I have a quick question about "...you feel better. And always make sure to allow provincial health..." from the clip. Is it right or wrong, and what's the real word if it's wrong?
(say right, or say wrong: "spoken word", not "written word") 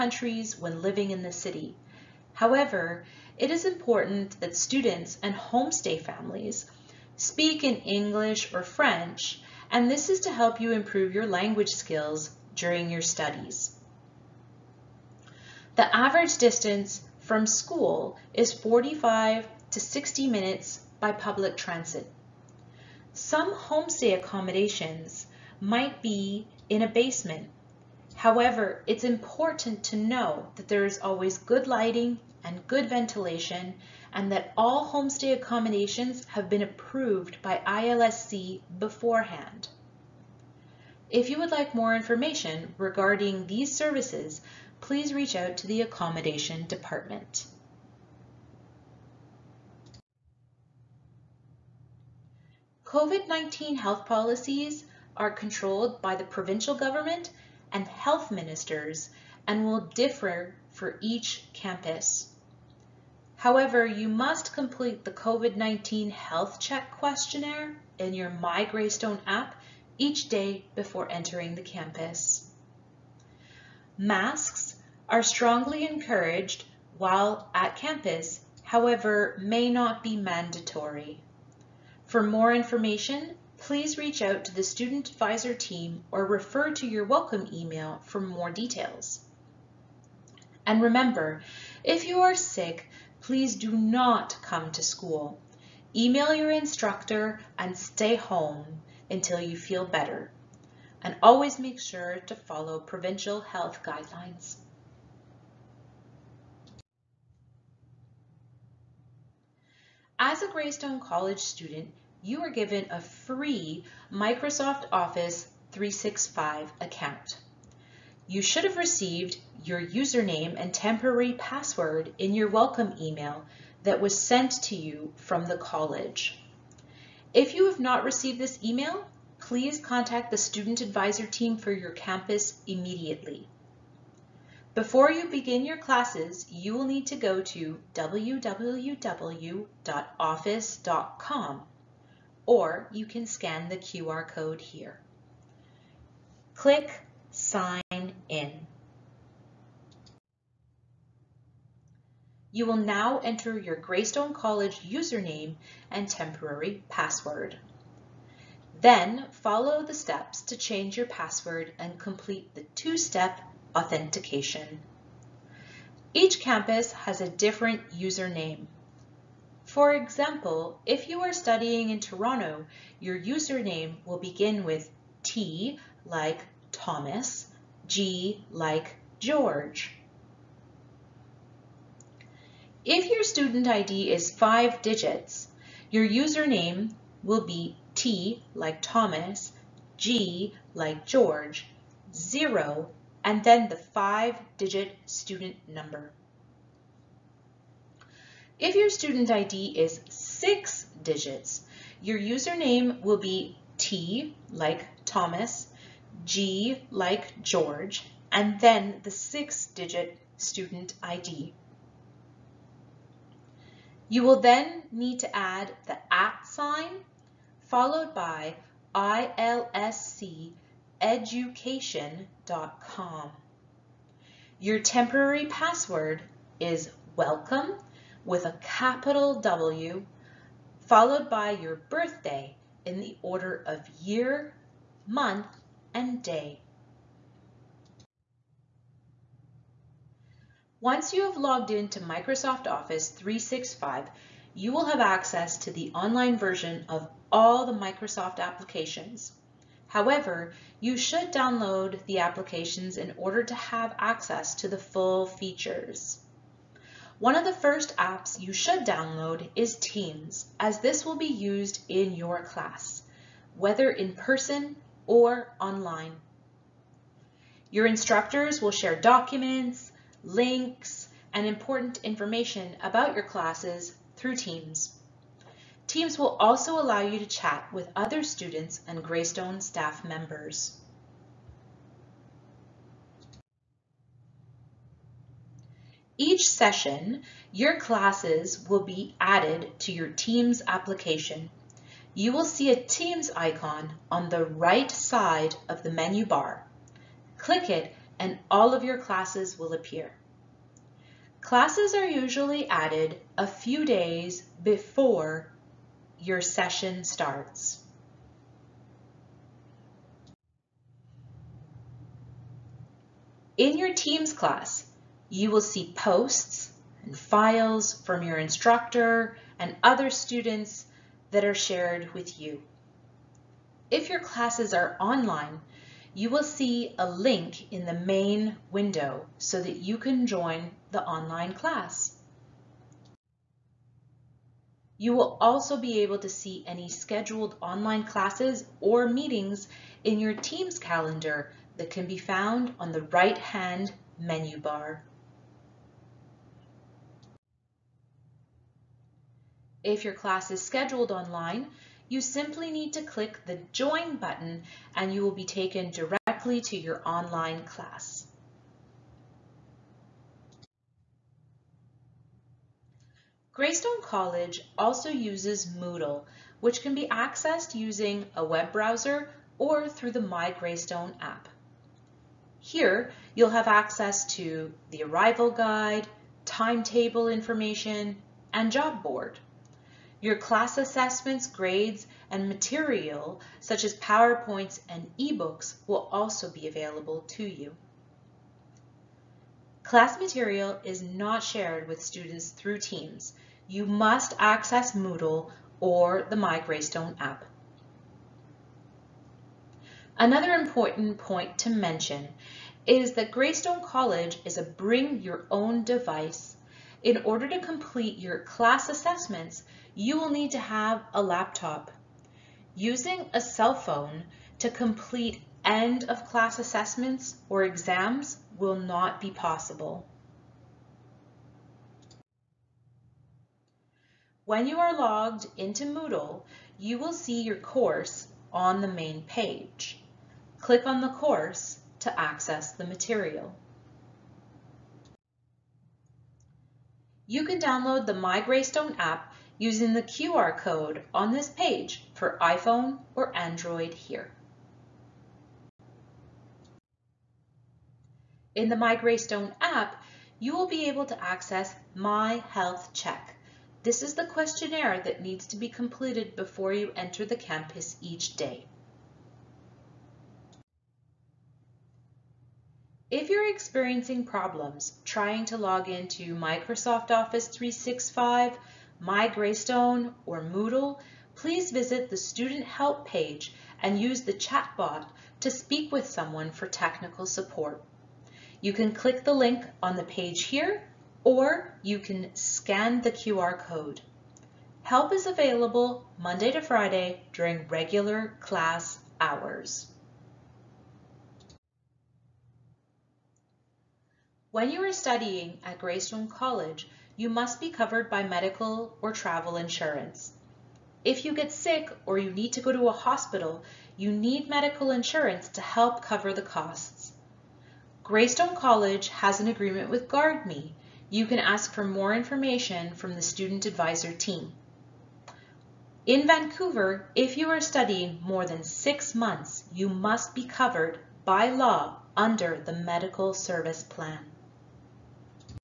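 wrong: "follow", not "allow".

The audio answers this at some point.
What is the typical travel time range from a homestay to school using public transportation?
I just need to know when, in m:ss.
0:18.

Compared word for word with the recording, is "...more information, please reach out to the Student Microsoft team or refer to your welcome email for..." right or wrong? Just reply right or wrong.
wrong.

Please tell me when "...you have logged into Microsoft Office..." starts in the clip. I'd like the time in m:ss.
4:01.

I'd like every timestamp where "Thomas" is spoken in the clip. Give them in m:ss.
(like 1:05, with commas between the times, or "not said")
2:56, 3:08, 3:25.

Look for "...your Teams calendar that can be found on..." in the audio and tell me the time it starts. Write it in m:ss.
5:40.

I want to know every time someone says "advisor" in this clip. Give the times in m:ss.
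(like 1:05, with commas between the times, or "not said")
1:25, 2:10, 8:33.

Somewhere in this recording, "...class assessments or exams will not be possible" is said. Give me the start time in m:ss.
6:56.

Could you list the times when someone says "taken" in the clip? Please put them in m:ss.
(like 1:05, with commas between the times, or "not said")
5:55.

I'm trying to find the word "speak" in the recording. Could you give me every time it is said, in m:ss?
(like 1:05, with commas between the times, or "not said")
0:07, 7:55.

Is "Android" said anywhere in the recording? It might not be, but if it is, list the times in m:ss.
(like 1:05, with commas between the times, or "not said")
7:23.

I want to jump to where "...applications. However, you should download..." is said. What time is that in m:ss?
4:08.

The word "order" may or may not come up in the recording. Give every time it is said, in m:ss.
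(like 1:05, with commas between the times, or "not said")
3:53, 4:13, 6:47.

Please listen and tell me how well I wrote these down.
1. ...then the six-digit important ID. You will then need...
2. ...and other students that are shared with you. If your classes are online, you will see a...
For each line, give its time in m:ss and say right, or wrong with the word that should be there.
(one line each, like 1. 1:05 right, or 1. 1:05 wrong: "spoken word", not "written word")
1. 3:28 wrong: "student", not "important"
2. 5:19 right.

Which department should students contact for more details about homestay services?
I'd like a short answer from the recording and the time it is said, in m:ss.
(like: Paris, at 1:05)
Accommodation Department, at 0:45.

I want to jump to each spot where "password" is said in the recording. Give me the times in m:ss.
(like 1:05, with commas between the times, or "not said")
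2:01, 2:36, 2:41, 3:45.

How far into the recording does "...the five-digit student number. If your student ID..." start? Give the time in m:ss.
3:13.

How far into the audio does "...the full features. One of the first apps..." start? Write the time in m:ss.
4:14.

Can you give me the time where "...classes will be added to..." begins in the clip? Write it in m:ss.
4:47.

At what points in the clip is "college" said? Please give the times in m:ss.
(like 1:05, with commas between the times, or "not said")
1:50, 2:05, 2:34, 6:04, 6:43, 8:16, 8:28.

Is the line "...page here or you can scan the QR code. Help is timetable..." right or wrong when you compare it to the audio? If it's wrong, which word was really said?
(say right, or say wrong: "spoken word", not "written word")
wrong: "available", not "timetable".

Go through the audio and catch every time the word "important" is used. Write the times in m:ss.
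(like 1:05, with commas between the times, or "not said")
0:03, 0:29, 4:31, 6:40.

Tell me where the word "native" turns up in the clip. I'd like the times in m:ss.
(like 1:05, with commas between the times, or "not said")
not said.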